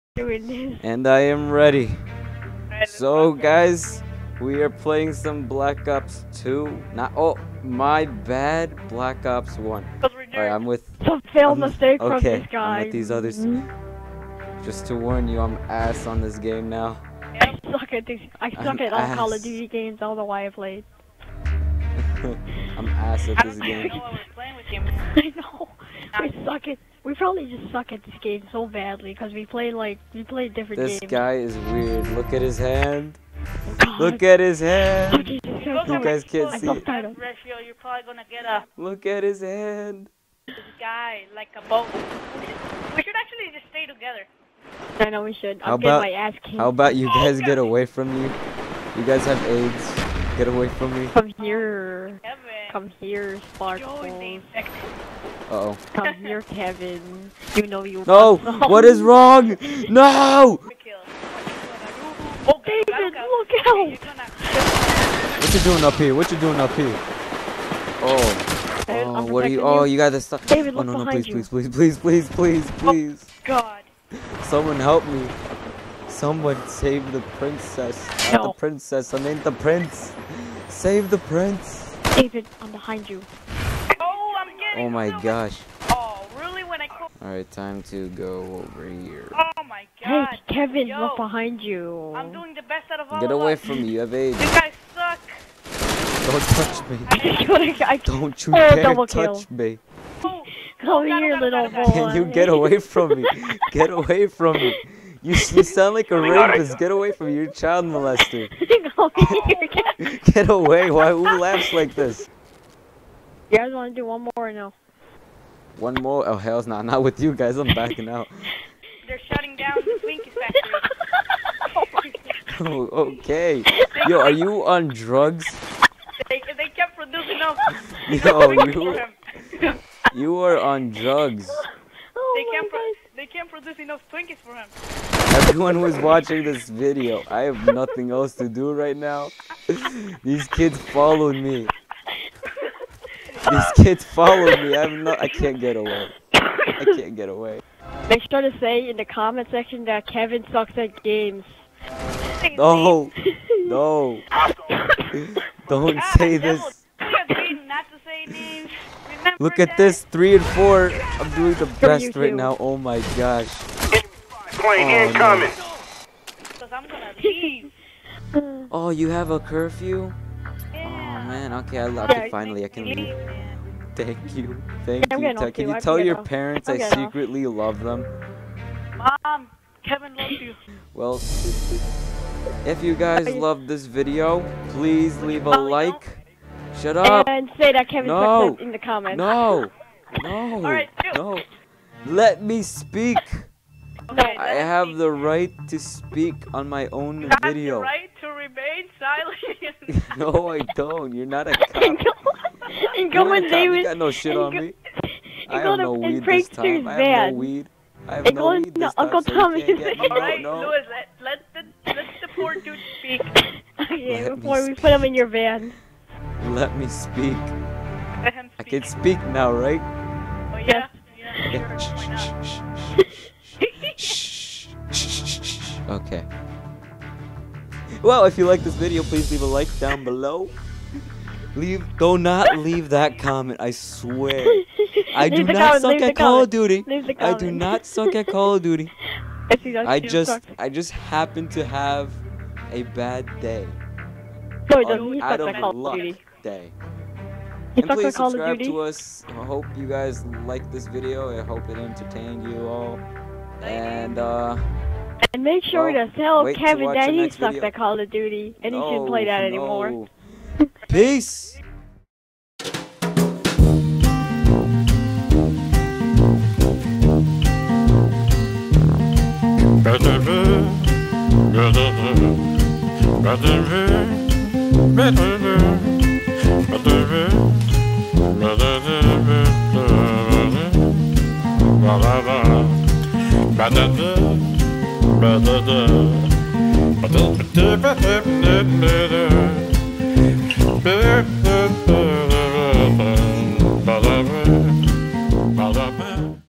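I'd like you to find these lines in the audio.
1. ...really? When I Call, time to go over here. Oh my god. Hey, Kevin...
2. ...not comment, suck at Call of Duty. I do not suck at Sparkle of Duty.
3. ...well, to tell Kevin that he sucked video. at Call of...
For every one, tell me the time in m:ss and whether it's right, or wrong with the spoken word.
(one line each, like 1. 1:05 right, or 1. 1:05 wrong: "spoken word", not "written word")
1. 1:26 wrong: "Alright", not "Call"
2. 3:55 wrong: "Call", not "Sparkle"
3. 4:15 right.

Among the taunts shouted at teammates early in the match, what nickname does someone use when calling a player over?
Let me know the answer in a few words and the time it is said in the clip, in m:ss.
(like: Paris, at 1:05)
Sparkle, at 0:53.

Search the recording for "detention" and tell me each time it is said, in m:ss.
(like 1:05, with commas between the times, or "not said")
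not said.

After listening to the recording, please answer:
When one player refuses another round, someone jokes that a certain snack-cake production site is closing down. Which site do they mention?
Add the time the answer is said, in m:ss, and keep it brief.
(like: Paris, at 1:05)
Twinkies factory, at 2:00.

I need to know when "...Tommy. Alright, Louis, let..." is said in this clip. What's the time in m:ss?
3:29.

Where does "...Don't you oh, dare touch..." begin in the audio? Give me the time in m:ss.
1:38.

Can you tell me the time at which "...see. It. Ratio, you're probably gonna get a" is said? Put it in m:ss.
0:36.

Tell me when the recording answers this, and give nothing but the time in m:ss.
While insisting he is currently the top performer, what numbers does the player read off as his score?
2:40.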